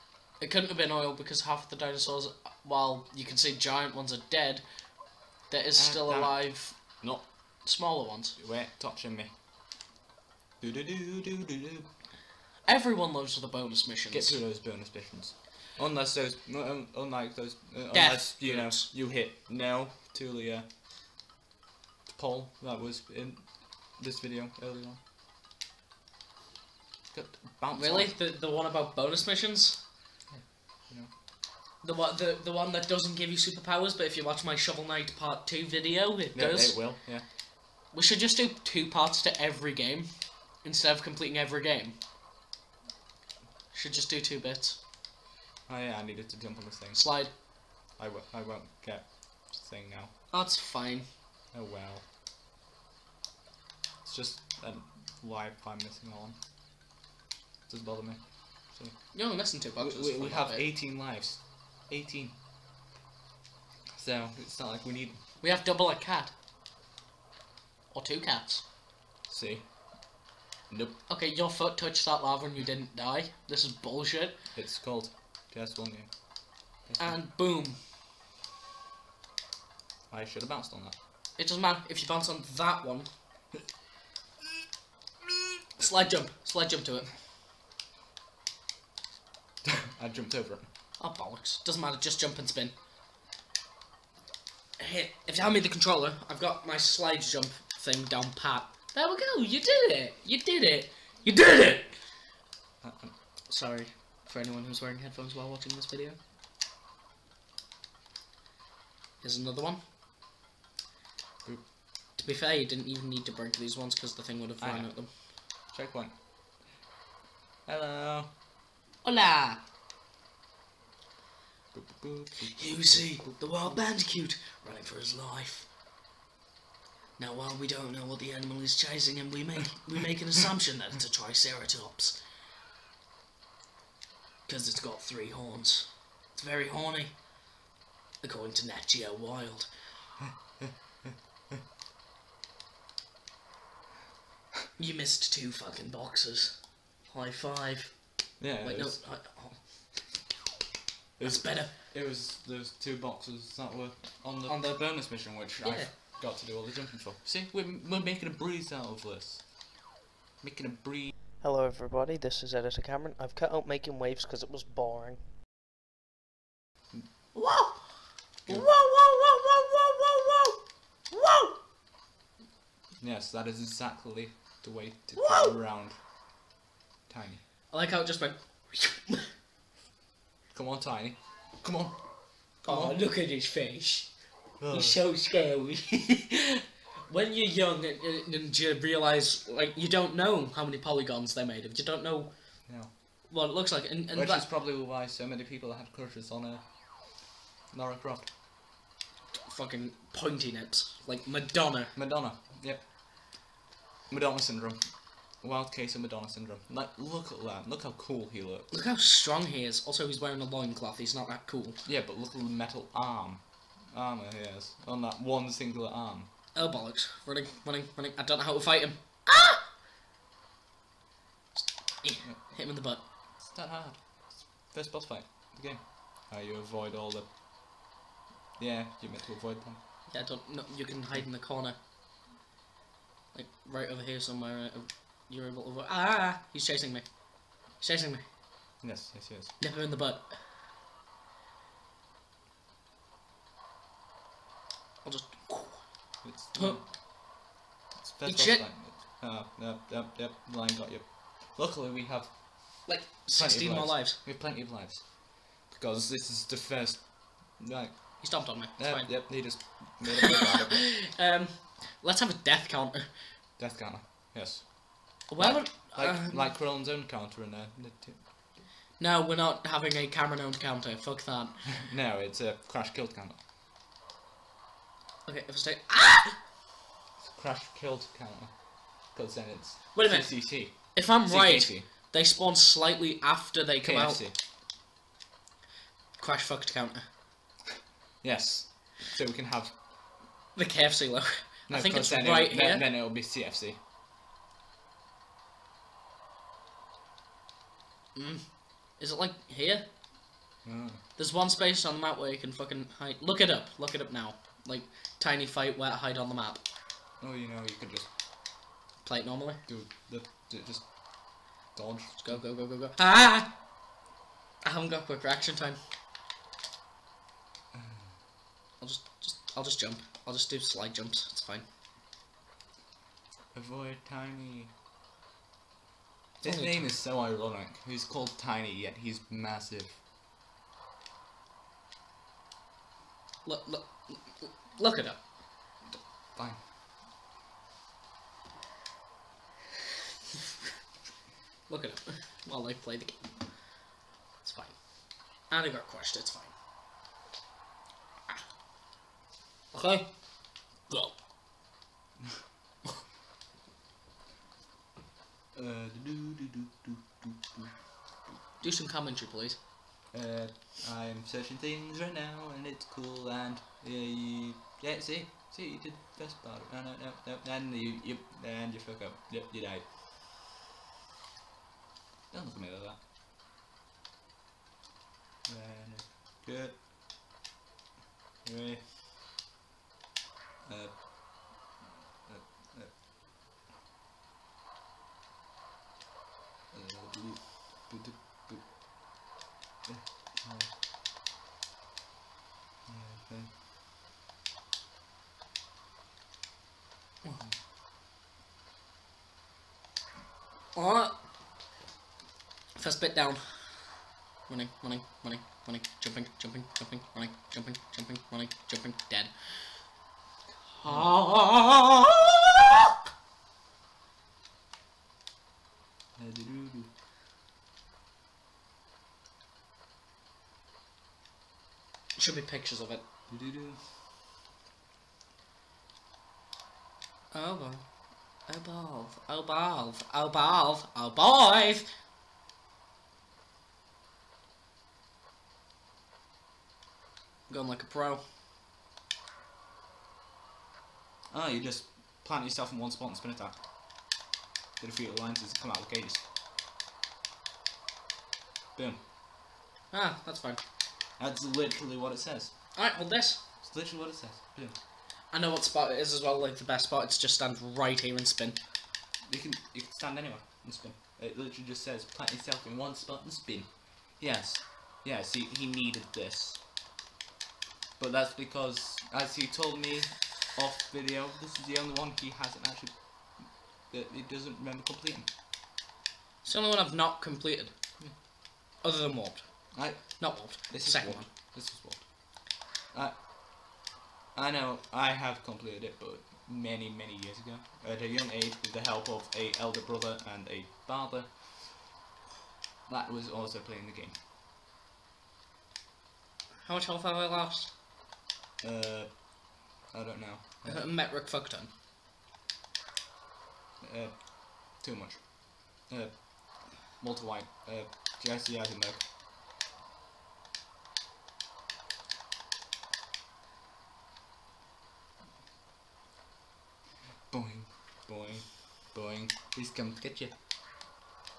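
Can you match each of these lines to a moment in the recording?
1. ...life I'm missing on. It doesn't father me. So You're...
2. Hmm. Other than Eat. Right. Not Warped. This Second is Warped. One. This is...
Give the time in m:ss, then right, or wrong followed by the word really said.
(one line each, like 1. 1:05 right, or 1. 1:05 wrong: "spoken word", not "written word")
1. 0:55 wrong: "bother", not "father"
2. 7:58 wrong: "Warped", not "Eat".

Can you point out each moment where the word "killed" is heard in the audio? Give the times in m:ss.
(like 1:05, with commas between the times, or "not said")
4:32, 4:37.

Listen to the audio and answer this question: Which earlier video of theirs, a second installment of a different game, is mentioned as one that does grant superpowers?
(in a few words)
Shovel Knight Part Two.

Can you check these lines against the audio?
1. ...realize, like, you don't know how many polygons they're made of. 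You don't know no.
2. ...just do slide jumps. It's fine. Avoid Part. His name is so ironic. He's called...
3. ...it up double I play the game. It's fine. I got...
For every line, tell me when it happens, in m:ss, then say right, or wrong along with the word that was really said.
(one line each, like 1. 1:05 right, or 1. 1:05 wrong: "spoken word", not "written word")
1. 3:08 right
2. 5:20 wrong: "Tiny", not "Part"
3. 5:41 wrong: "while", not "double".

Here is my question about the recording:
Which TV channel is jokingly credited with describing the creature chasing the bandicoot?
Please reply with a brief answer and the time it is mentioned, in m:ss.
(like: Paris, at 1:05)
Nat Geo Wild, at 2:18.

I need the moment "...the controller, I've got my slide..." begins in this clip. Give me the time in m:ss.
1:35.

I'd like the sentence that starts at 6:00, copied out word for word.
Uh, I'm searching things right now, and it's cool, and...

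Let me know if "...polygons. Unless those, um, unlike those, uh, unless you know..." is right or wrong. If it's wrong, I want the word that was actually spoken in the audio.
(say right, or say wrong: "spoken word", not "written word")
wrong: "missions", not "polygons".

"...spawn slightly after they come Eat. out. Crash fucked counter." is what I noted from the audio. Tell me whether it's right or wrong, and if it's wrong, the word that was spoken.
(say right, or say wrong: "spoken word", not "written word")
wrong: "KFC", not "Eat".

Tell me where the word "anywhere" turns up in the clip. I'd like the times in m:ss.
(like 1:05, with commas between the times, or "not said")
7:40.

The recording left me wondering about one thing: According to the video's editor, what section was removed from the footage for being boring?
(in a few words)
Making Waves.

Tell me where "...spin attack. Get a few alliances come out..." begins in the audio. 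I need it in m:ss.
7:23.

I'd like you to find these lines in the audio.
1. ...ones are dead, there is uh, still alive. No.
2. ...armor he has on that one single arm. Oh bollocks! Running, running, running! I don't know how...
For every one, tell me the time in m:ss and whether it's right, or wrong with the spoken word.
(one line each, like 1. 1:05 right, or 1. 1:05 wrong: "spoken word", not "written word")
1. 0:03 right
2. 3:33 right.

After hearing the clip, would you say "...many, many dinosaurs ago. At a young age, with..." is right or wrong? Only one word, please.
wrong.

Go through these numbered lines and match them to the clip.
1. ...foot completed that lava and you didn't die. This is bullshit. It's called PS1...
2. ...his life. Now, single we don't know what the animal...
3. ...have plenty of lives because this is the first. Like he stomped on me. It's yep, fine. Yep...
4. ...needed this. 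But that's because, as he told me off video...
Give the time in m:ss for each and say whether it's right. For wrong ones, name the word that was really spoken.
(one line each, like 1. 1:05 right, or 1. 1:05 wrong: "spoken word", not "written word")
1. 1:11 wrong: "touched", not "completed"
2. 2:04 wrong: "while", not "single"
3. 4:14 right
4. 7:45 right.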